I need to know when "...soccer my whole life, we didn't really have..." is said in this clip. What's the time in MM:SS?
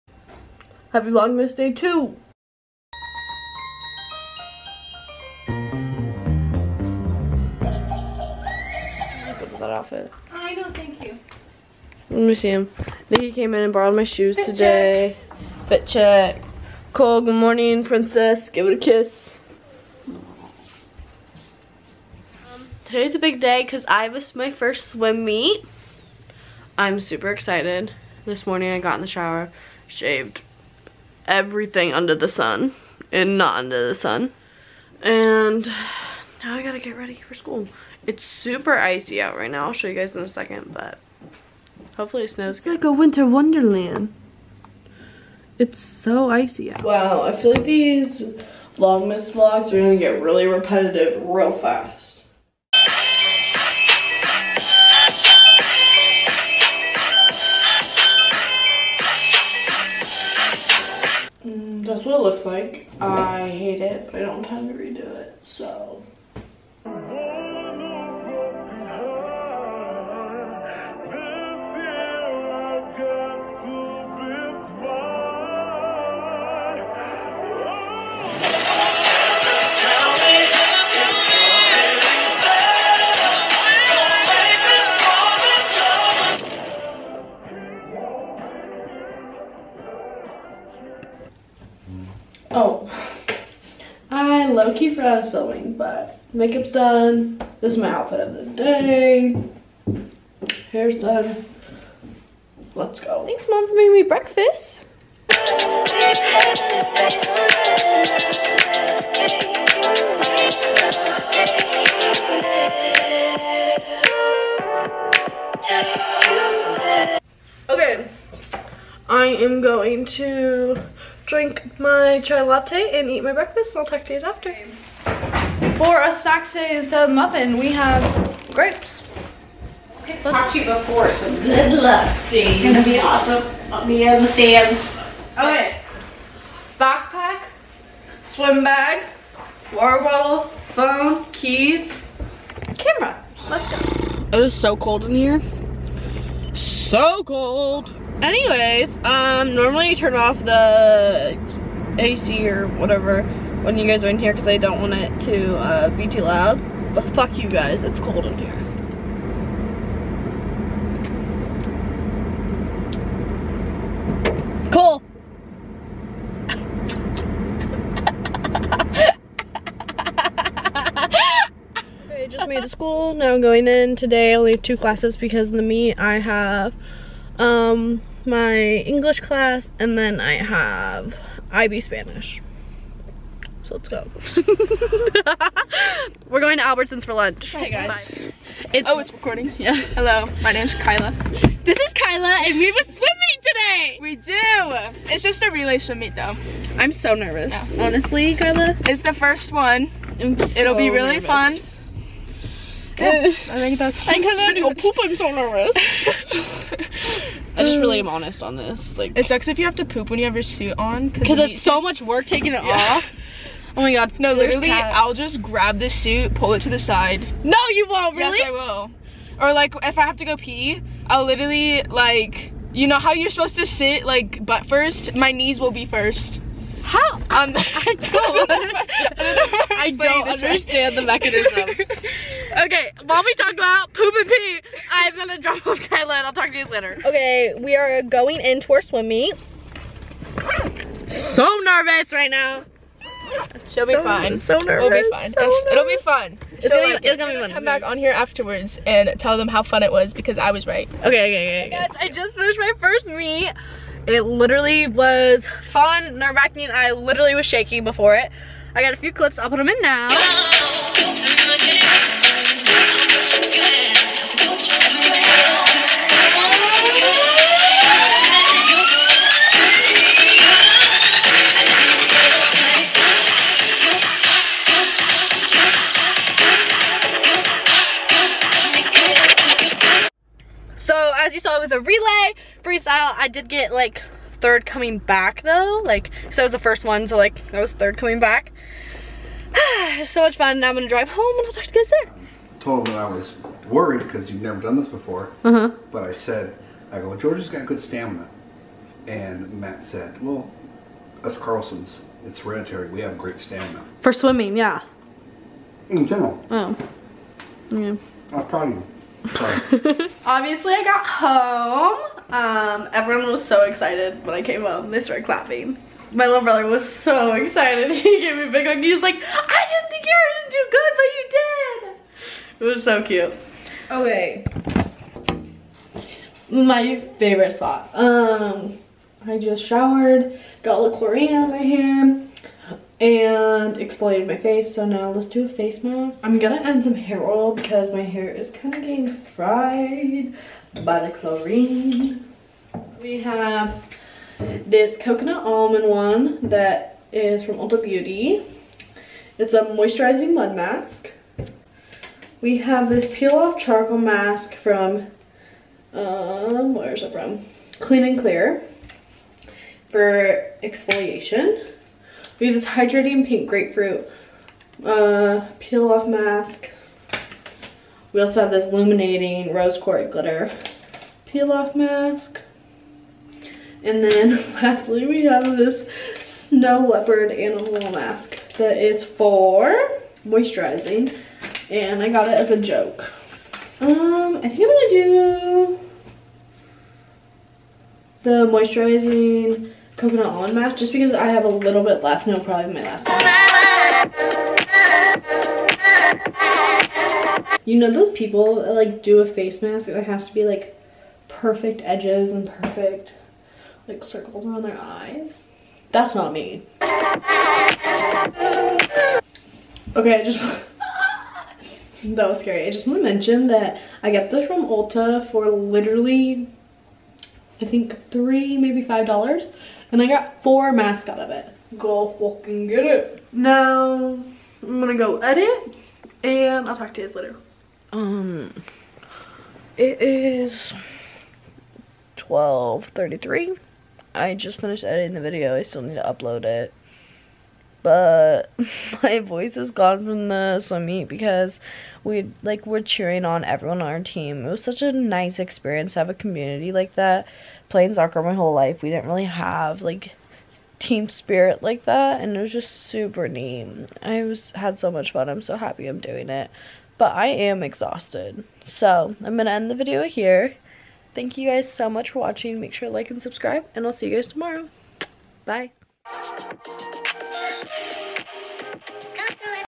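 07:27.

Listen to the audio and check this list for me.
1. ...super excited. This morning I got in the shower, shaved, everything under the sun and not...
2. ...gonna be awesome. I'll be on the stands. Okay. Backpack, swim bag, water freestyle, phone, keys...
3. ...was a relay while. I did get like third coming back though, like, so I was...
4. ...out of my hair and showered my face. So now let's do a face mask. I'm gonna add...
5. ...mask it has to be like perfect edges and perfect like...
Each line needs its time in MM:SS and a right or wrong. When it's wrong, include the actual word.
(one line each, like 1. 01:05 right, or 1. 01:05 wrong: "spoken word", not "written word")
1. 00:26 right
2. 02:12 wrong: "bottle", not "freestyle"
3. 04:41 wrong: "freestyle", not "while"
4. 05:31 wrong: "exfoliated", not "showered"
5. 06:39 right.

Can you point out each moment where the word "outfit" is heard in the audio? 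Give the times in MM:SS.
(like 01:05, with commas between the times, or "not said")
00:09, 01:37.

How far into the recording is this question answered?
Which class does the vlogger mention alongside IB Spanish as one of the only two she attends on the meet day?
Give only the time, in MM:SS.
02:58.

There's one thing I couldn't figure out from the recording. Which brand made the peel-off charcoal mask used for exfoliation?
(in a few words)
Clean and Clear.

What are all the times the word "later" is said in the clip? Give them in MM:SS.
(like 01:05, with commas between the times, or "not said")
03:56, 07:07.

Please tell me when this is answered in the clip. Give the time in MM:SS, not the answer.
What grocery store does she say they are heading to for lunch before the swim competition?
03:06.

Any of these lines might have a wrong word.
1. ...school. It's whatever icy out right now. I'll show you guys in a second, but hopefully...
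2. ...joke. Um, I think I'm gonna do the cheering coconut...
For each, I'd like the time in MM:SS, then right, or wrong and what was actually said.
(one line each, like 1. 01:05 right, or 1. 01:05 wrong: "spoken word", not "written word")
1. 00:37 wrong: "super", not "whatever"
2. 06:22 wrong: "moisturizing", not "cheering".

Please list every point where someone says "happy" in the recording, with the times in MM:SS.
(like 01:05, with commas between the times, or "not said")
00:00, 07:35.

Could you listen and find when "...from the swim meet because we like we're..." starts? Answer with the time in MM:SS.
07:20.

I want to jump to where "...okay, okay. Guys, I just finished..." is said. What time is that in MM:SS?
04:11.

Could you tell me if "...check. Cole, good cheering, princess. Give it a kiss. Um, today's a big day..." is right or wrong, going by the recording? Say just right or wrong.
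wrong.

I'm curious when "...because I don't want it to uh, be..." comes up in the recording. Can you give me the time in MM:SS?
02:34.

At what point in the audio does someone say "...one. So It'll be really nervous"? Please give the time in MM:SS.
03:19.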